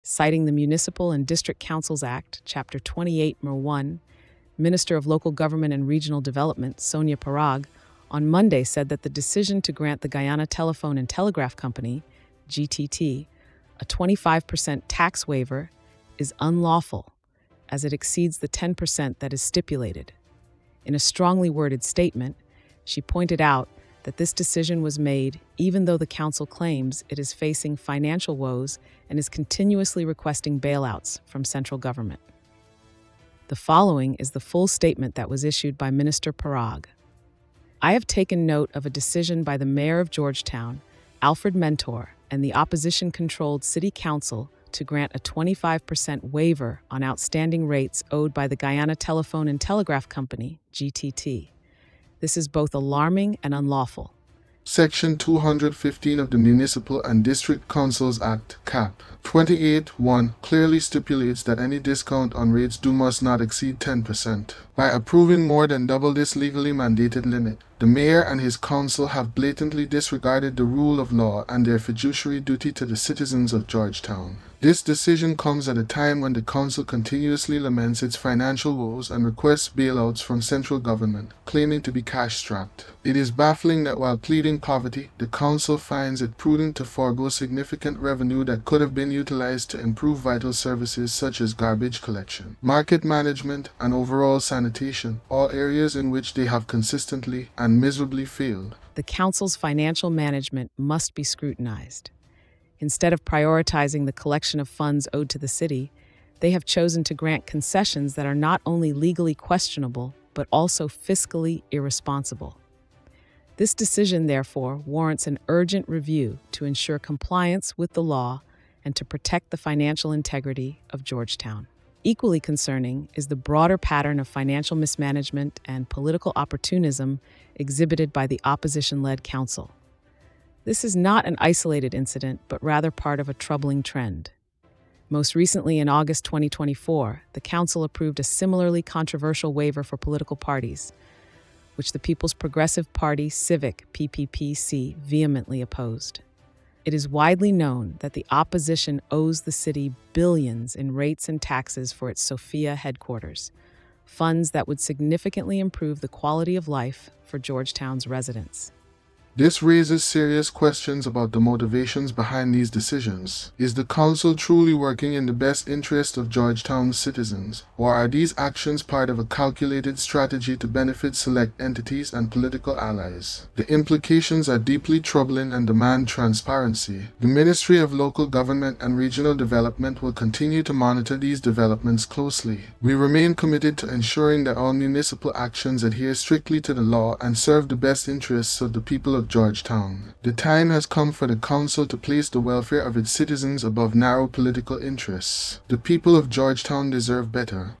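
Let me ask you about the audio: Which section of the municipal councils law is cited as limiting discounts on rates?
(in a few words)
Section 215.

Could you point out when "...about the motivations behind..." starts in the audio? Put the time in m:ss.
2:41.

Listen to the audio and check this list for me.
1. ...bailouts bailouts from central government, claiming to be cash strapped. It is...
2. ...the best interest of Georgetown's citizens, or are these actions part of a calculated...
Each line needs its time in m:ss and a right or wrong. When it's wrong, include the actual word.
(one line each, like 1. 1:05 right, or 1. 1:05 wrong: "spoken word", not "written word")
1. 1:19 wrong: "requests", not "bailouts"
2. 2:45 right.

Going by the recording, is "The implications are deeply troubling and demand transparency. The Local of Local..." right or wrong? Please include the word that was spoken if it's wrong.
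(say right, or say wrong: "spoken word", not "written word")
wrong: "Ministry", not "Local".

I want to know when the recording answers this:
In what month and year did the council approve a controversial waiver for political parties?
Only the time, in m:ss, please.
2:15.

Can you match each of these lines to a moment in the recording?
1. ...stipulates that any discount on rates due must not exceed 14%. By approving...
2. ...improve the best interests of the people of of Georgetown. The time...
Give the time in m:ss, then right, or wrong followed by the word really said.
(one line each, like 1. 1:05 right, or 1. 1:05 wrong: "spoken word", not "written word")
1. 1:00 wrong: "10", not "14"
2. 3:07 wrong: "serve", not "improve".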